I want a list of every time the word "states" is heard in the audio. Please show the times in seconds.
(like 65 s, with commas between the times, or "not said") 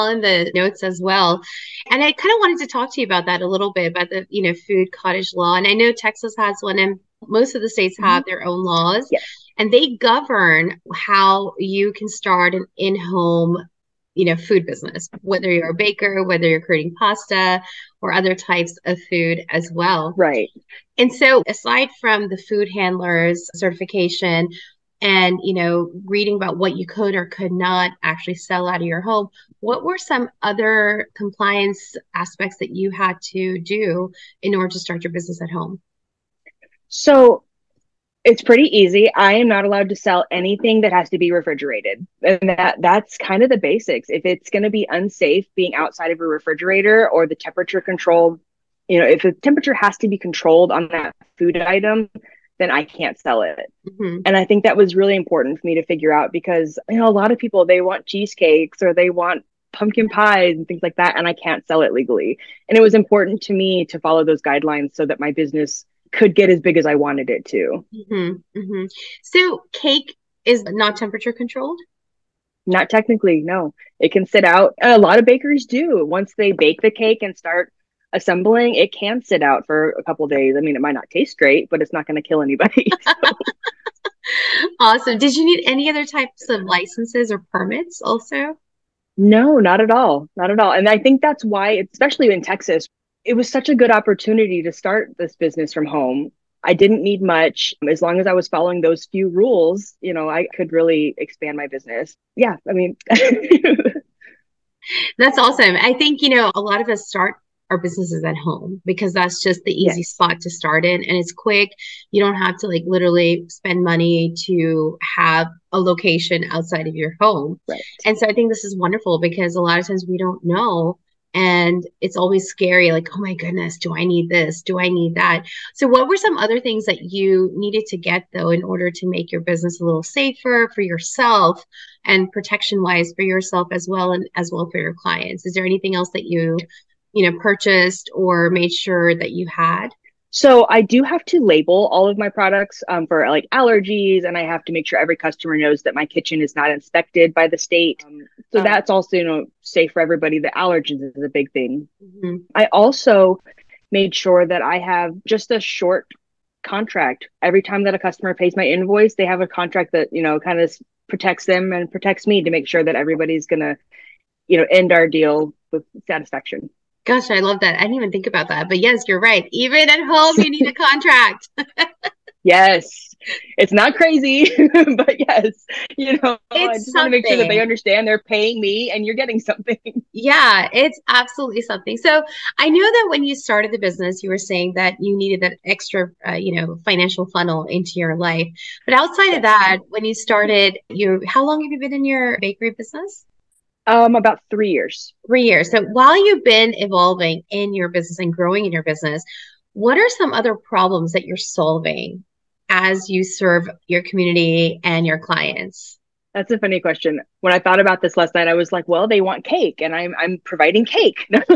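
7 s, 147 s.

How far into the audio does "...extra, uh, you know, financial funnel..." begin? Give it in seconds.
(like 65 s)
185 s.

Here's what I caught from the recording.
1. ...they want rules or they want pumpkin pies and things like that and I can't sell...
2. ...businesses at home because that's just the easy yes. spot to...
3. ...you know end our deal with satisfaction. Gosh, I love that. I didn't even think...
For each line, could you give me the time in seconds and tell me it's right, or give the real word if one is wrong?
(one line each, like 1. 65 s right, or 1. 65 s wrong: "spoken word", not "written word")
1. 57 s wrong: "cheesecakes", not "rules"
2. 107 s right
3. 164 s right.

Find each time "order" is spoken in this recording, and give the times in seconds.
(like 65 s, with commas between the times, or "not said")
34 s, 128 s.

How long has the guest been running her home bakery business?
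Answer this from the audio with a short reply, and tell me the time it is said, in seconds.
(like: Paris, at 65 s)
About 3 years, at 194 s.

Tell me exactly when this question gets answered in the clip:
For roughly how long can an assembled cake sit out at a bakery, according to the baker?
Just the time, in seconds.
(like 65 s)
79 s.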